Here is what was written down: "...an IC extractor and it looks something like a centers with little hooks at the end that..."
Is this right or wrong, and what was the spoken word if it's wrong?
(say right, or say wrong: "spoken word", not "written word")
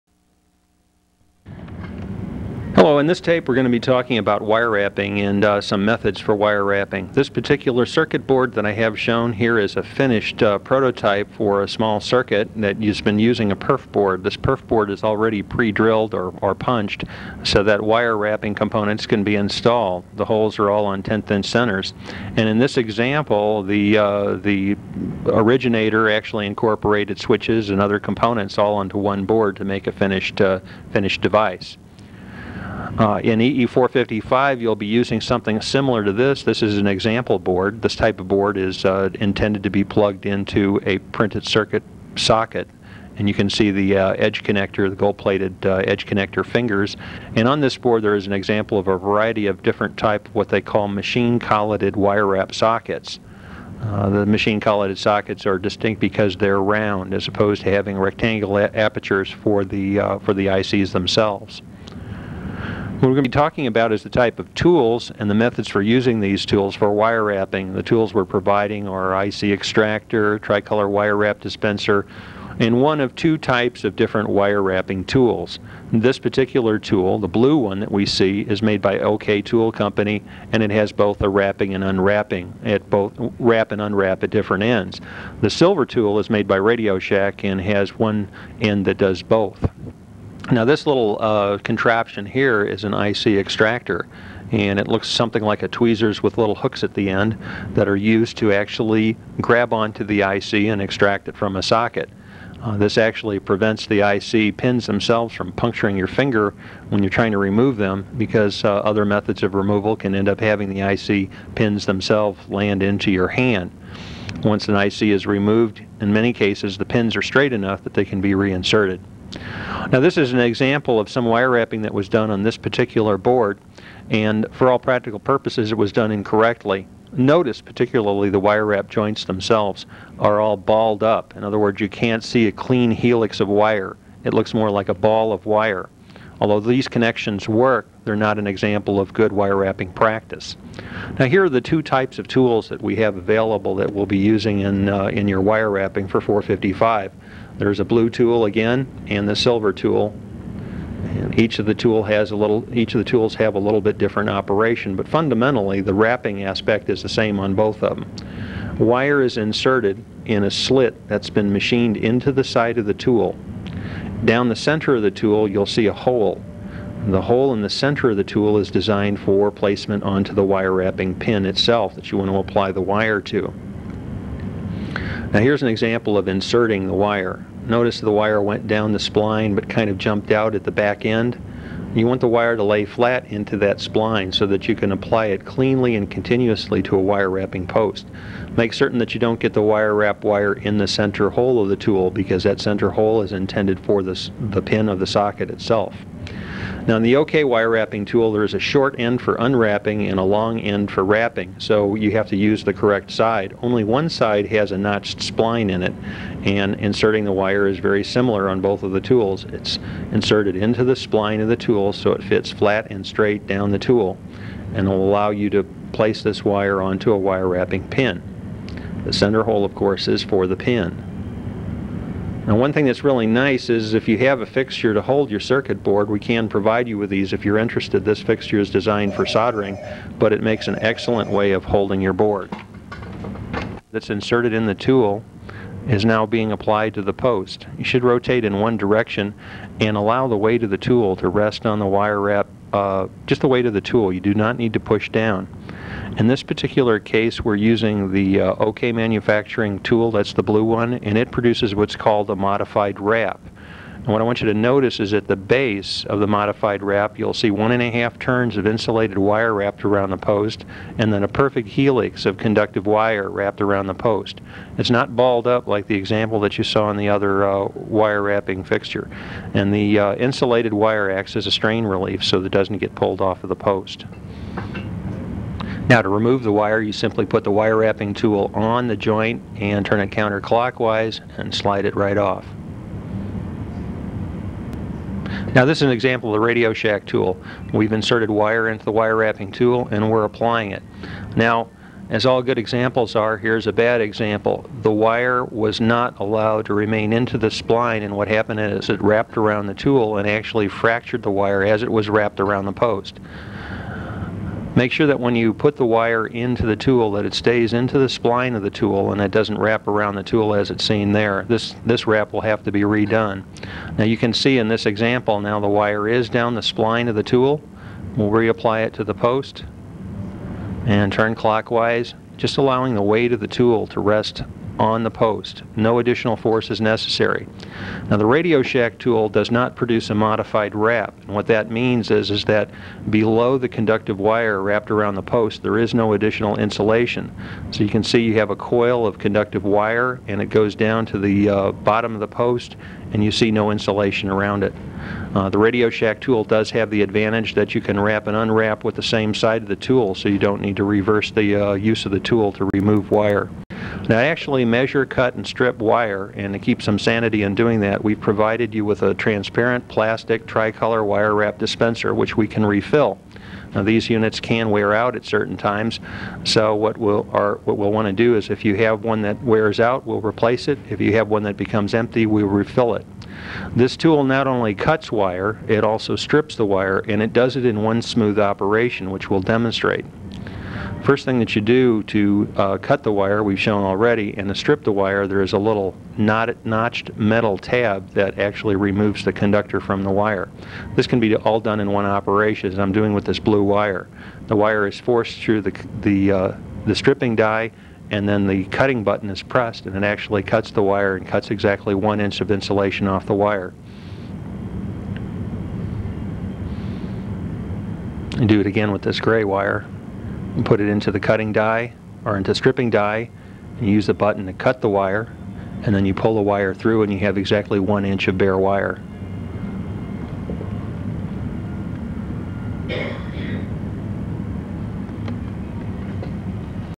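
wrong: "tweezers", not "centers".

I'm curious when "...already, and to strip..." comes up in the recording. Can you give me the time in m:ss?
6:23.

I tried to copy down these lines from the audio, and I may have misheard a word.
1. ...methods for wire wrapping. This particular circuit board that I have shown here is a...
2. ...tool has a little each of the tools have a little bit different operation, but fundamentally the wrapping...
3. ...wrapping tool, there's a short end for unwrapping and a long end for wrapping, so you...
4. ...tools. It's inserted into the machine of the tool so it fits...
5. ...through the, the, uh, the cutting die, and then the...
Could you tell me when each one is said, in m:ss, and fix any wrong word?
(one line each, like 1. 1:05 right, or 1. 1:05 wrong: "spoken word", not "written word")
1. 0:05 right
2. 2:31 right
3. 3:17 right
4. 3:29 wrong: "spline", not "machine"
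5. 6:35 wrong: "stripping", not "cutting".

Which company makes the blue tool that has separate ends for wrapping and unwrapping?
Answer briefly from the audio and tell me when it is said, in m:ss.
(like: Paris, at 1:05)
OK Tool Company, at 1:18.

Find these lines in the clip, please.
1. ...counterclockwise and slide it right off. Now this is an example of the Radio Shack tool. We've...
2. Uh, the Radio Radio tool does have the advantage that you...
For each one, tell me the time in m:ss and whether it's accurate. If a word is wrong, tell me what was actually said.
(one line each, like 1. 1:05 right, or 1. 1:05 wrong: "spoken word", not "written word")
1. 4:40 right
2. 5:45 wrong: "Shack", not "Radio".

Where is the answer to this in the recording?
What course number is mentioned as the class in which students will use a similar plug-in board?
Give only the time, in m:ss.
0:33.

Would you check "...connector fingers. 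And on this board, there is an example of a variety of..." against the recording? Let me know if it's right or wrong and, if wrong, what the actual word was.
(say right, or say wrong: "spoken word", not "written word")
right.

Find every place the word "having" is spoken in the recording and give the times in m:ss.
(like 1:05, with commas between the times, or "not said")
0:57, 1:50.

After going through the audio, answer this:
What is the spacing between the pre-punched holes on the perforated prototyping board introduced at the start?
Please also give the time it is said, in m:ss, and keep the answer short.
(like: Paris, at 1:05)
10th inch centers, at 0:21.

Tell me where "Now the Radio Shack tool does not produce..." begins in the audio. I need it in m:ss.
5:28.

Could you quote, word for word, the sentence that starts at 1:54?
Once an IC is removed, in many cases the pins are straight enough that they can be reinserted.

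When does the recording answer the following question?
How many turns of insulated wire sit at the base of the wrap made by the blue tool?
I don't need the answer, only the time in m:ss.
4:17.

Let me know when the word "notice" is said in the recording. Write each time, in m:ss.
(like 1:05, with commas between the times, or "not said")
2:07, 2:57, 4:14.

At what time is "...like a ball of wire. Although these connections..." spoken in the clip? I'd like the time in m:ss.
2:14.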